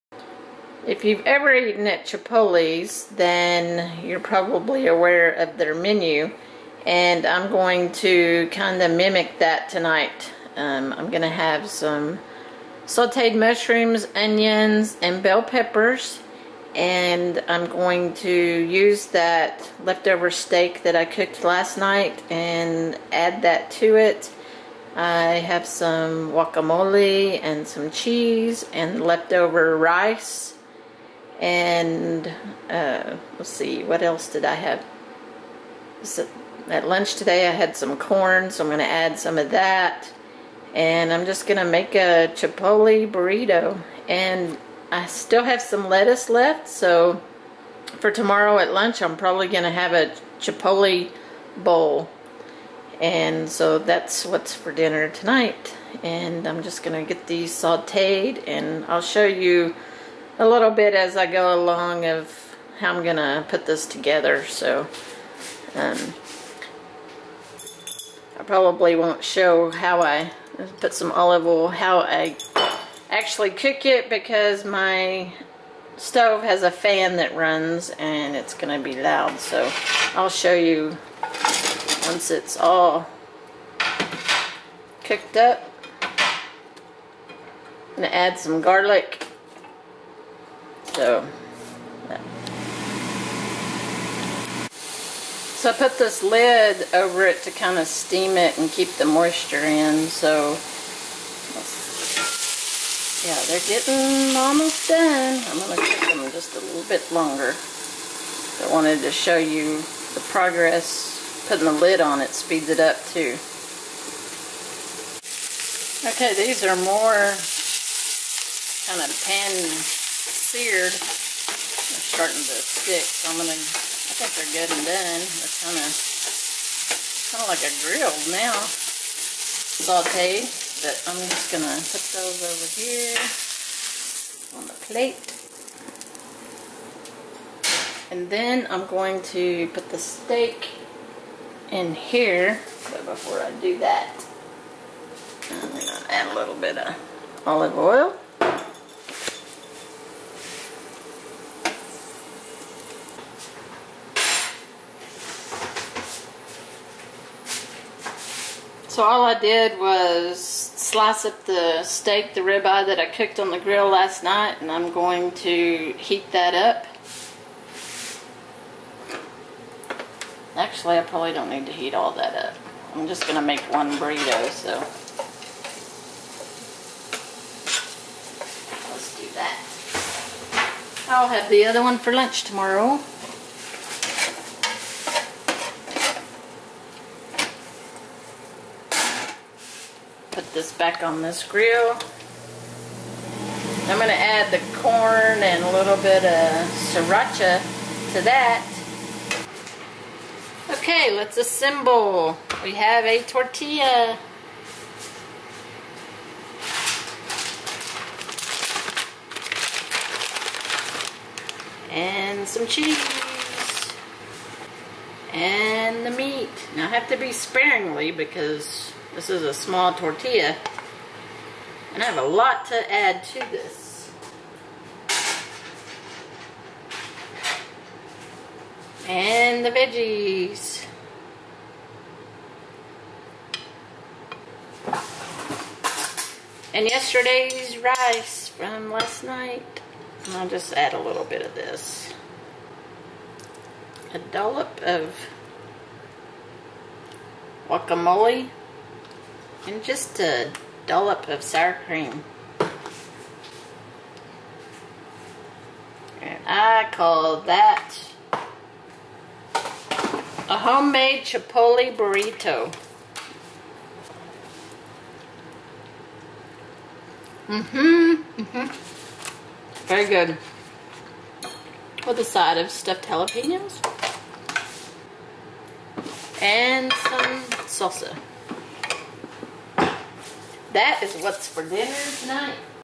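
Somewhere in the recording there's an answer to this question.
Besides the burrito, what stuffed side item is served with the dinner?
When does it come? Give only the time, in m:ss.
4:32.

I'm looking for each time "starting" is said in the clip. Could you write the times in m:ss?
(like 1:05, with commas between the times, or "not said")
2:02.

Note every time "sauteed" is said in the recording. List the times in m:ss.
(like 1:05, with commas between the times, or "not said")
0:12, 0:57, 2:09.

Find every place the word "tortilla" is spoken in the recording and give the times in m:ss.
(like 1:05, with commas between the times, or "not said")
3:23, 3:39.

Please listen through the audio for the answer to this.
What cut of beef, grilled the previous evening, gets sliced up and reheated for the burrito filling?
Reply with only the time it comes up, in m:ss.
2:42.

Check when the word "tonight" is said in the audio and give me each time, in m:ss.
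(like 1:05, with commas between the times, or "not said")
0:09, 0:55, 4:42.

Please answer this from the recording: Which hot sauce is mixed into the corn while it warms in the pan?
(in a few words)
sriracha.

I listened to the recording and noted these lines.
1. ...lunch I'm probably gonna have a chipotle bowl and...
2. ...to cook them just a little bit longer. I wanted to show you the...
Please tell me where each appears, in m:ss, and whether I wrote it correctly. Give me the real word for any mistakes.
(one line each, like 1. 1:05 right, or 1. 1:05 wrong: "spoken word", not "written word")
1. 0:48 right
2. 1:45 right.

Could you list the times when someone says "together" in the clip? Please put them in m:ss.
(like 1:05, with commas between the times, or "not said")
1:03.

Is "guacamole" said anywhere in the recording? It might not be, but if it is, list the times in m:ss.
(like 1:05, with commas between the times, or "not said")
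0:26, 4:07.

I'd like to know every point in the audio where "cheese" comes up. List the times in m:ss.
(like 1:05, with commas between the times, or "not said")
0:27, 3:32.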